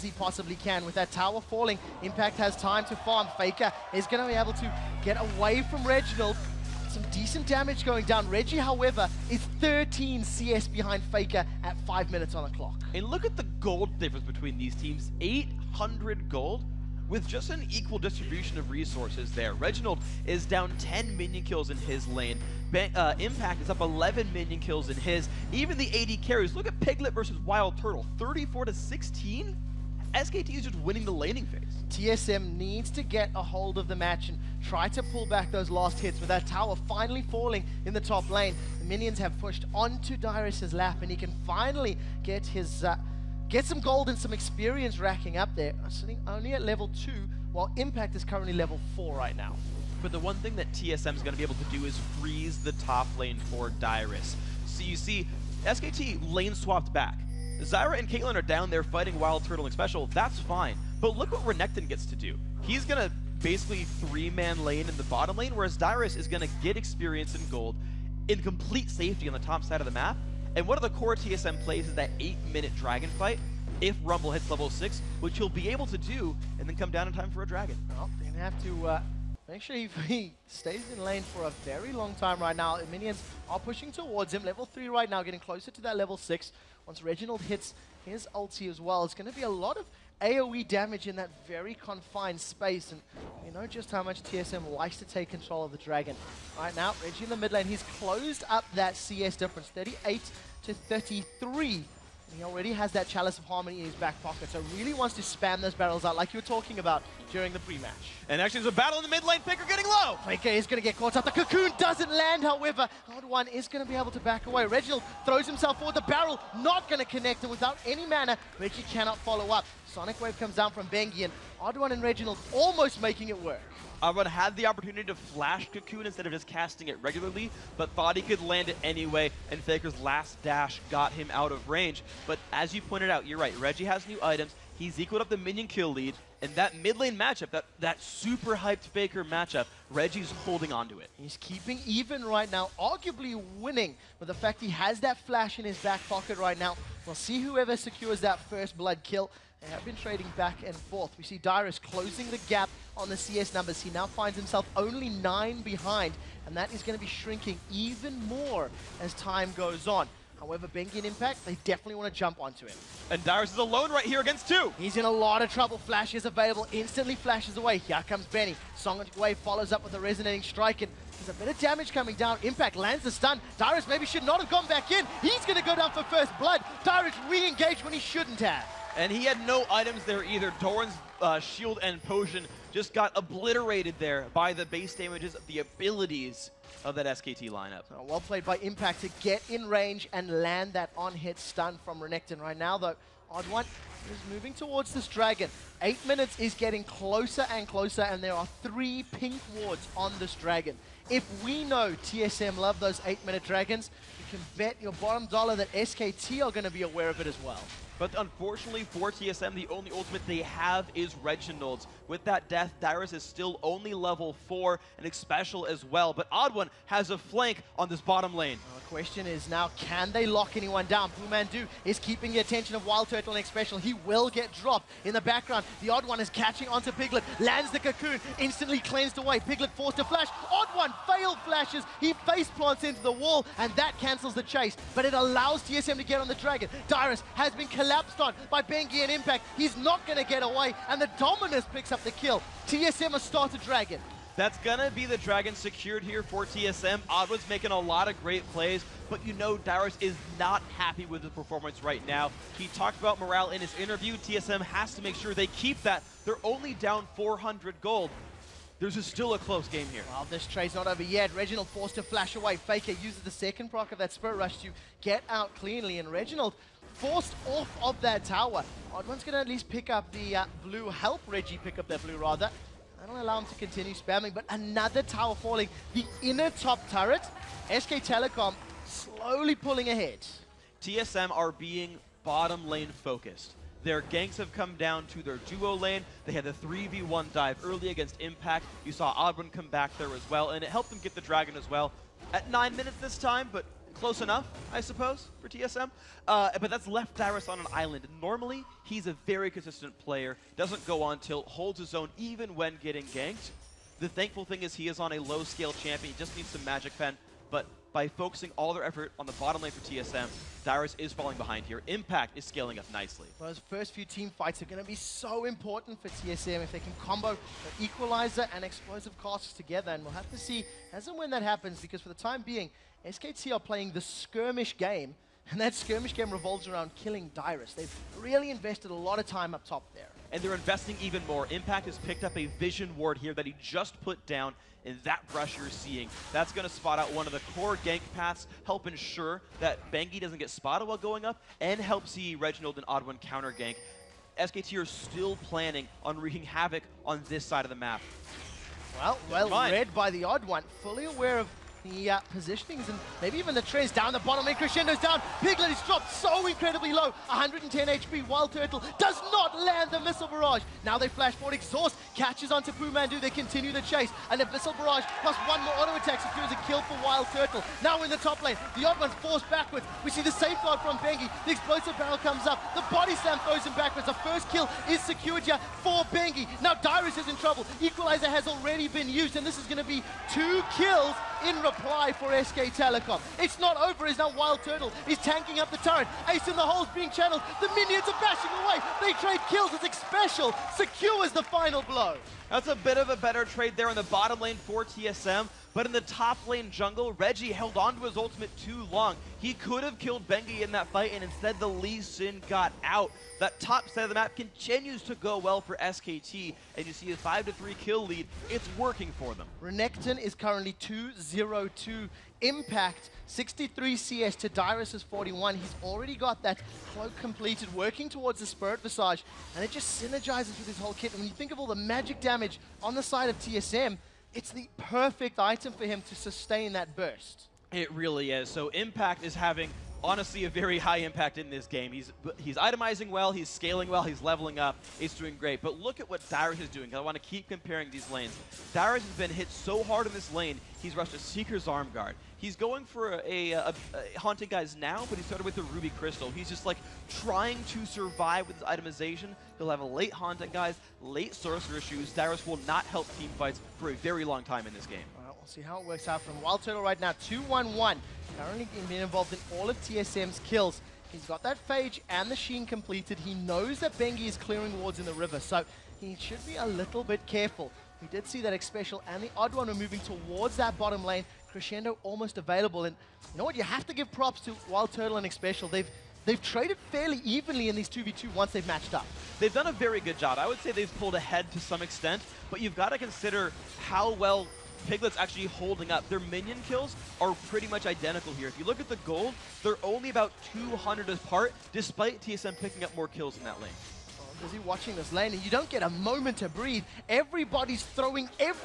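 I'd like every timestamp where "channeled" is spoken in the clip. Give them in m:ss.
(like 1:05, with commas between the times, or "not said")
6:27.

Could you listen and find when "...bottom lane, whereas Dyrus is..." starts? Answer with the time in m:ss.
1:05.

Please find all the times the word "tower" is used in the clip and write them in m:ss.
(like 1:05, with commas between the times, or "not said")
0:01, 0:36, 4:28, 4:35.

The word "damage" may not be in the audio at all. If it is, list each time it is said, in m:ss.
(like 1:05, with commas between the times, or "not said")
0:07, 1:30, 2:51, 3:04, 7:02.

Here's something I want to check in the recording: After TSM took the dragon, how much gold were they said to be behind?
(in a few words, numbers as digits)
400.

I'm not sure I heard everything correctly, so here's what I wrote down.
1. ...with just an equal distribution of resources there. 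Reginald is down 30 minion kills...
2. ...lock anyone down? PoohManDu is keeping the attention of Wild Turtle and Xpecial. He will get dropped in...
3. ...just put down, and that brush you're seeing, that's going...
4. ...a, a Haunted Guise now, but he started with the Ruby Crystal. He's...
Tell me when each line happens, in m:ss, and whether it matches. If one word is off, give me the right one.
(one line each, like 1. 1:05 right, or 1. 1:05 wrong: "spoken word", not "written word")
1. 0:17 wrong: "10", not "30"
2. 3:40 right
3. 5:33 right
4. 7:23 right.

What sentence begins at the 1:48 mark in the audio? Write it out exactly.
And actually there's a battle in the mid lane, Faker getting low!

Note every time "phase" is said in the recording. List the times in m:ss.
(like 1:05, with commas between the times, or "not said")
0:31.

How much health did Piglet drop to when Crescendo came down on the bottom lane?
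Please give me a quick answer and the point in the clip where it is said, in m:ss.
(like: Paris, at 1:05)
110, at 5:57.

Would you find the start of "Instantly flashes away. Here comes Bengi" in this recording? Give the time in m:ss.
2:46.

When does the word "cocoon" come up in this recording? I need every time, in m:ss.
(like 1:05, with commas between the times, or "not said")
1:51, 2:05, 3:47.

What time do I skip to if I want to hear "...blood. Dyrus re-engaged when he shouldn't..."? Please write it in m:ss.
2:56.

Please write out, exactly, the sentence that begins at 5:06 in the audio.
He just needs some magic pen.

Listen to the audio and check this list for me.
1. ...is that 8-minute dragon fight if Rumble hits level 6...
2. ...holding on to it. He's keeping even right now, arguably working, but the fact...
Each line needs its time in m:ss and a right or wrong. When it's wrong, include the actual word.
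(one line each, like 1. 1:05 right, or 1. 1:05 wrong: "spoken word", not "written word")
1. 1:11 right
2. 2:20 wrong: "winning", not "working".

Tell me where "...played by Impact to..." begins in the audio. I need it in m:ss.
3:08.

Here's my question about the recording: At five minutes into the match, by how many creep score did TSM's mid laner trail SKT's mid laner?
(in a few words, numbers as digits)
13.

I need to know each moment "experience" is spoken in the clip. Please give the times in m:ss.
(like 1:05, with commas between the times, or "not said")
0:44, 1:06.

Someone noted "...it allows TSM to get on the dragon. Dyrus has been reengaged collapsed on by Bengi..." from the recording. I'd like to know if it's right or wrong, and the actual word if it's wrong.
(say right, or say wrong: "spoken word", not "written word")
wrong: "collected", not "reengaged".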